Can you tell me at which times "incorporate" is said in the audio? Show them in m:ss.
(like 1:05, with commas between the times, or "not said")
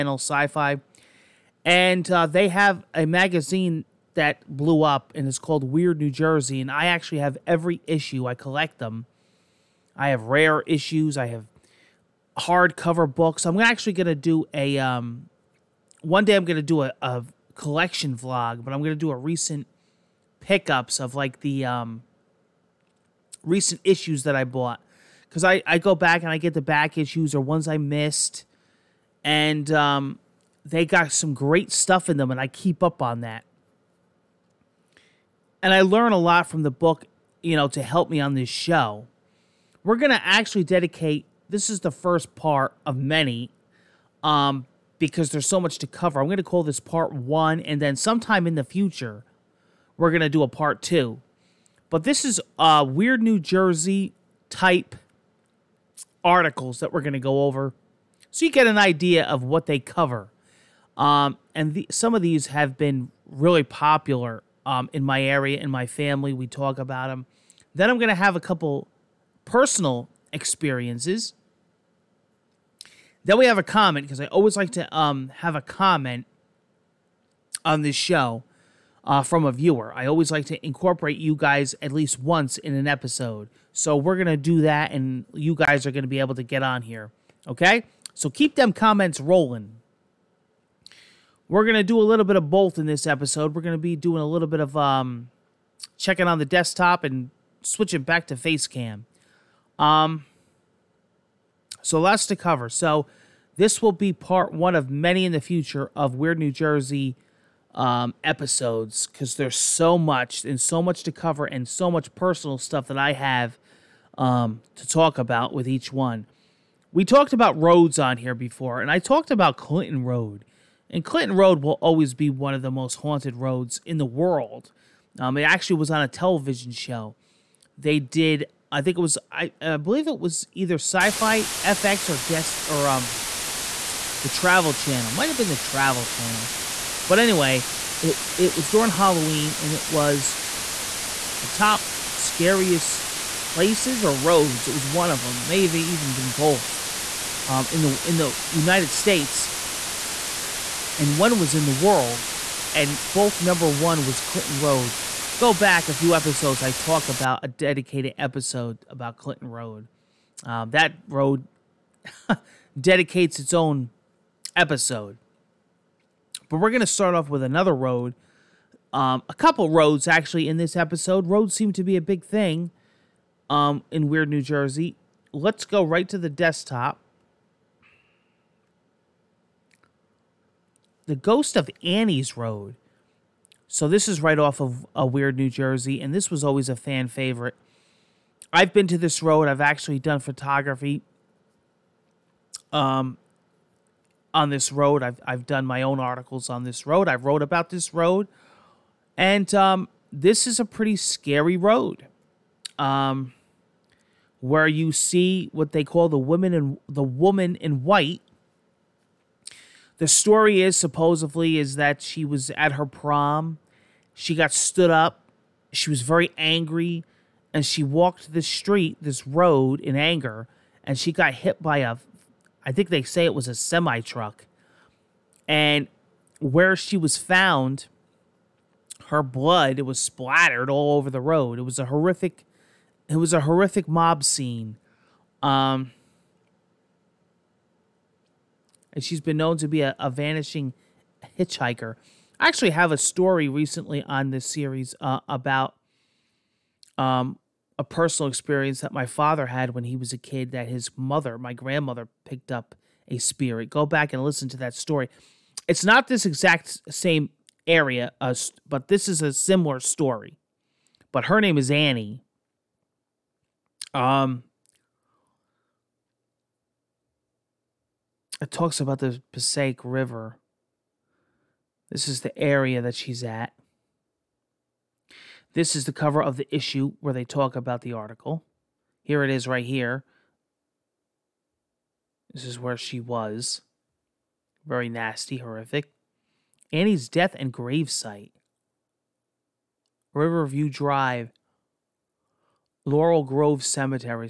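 1:20.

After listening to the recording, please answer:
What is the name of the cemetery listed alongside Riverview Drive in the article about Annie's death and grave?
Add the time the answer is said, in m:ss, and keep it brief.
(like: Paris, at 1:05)
Laurel Grove Cemetery, at 4:52.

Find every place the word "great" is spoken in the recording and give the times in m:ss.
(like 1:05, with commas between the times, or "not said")
0:31.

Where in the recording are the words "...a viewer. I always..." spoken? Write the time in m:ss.
1:19.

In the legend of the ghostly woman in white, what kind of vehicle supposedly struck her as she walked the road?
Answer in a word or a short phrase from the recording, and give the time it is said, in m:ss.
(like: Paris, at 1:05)
A semi truck, at 3:43.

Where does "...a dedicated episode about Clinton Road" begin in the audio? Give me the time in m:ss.
2:37.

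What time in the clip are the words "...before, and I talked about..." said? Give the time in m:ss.
1:58.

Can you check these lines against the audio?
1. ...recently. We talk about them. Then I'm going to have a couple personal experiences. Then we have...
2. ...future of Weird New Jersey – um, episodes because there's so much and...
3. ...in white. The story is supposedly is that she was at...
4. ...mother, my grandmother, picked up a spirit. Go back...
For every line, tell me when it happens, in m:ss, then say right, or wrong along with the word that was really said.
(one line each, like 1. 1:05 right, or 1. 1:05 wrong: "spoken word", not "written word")
1. 1:05 wrong: "family", not "recently"
2. 1:45 right
3. 3:27 right
4. 4:10 right.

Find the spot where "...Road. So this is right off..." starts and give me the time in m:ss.
3:02.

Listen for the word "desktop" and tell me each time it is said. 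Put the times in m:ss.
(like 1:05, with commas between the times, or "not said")
1:36, 2:56.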